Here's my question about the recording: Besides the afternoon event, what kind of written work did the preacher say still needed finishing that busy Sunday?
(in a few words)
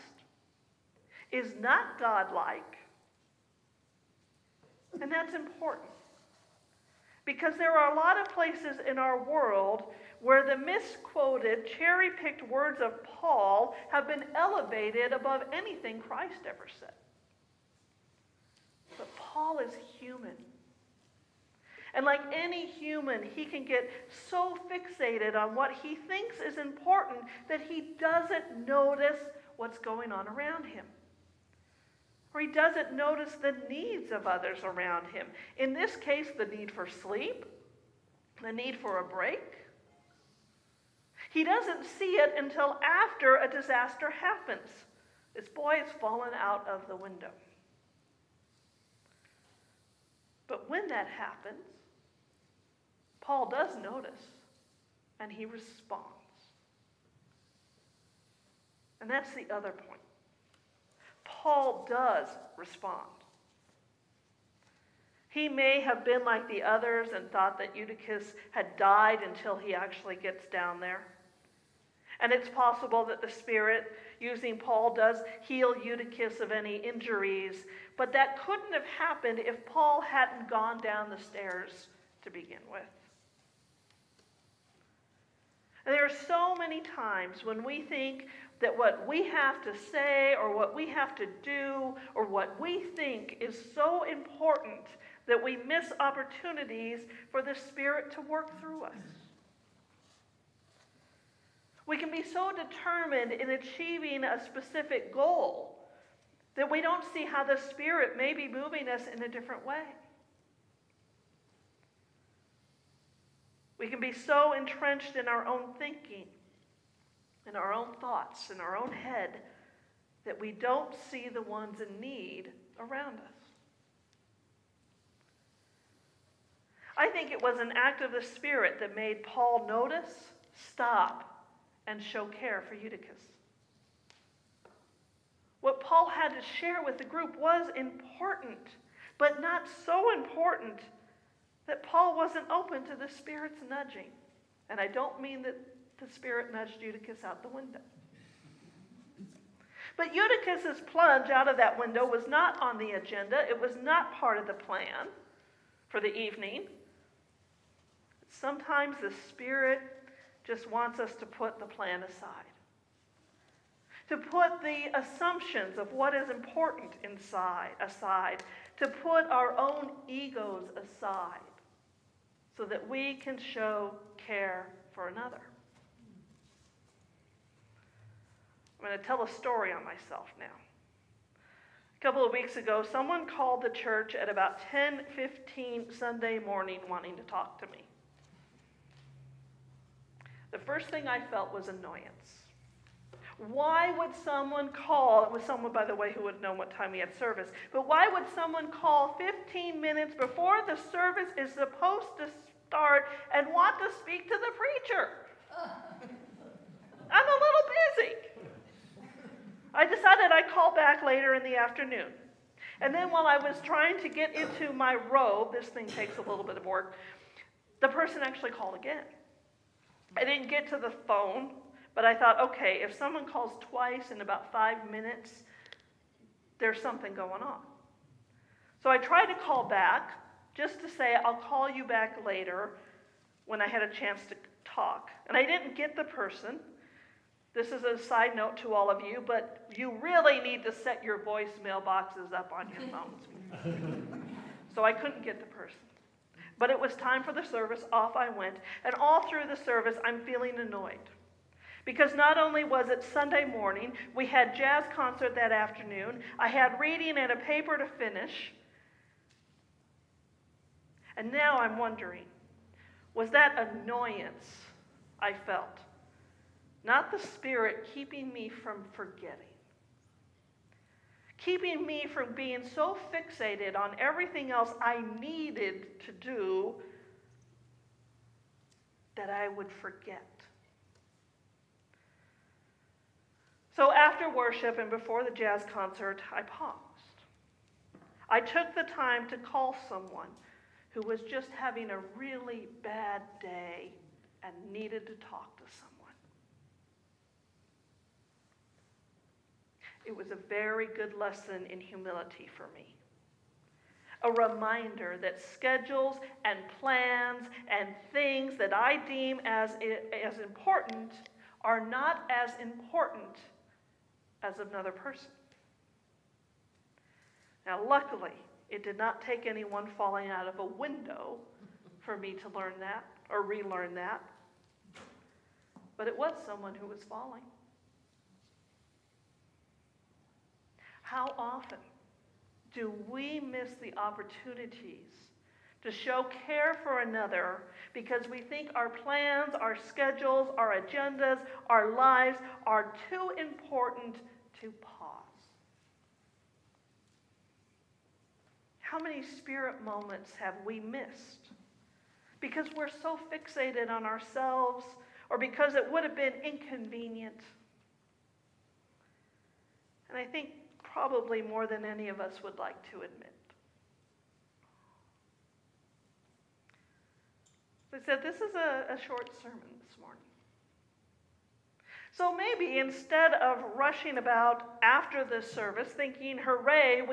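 a paper.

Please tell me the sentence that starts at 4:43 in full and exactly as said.
So after worship and before the jazz concert, I paused.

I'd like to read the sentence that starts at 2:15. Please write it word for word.
What Paul had to share with the group was important, but not so important that Paul wasn't open to the Spirit's nudging.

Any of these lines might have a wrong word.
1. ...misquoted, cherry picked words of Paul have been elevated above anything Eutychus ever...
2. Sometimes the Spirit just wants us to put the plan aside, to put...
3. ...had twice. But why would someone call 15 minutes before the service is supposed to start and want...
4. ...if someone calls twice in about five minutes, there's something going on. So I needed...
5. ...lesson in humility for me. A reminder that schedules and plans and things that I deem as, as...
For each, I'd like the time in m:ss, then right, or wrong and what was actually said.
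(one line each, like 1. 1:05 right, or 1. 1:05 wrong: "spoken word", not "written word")
1. 0:10 wrong: "Christ", not "Eutychus"
2. 2:38 right
3. 3:16 wrong: "service", not "twice"
4. 3:42 wrong: "tried", not "needed"
5. 5:01 right.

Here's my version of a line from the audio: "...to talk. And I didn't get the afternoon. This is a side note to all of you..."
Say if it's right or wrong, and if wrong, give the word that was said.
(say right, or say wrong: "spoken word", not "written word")
wrong: "person", not "afternoon".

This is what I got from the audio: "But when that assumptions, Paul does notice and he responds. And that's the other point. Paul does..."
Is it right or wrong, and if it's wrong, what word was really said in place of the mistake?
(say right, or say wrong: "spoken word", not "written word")
wrong: "happens", not "assumptions".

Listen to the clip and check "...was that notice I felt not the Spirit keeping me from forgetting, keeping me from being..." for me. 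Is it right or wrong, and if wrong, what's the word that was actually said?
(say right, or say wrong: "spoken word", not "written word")
wrong: "annoyance", not "notice".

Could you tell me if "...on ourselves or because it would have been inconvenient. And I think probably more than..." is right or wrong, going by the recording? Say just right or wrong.
right.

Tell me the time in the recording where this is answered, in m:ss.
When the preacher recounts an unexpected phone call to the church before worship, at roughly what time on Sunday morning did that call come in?
3:04.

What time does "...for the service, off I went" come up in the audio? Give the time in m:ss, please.
4:07.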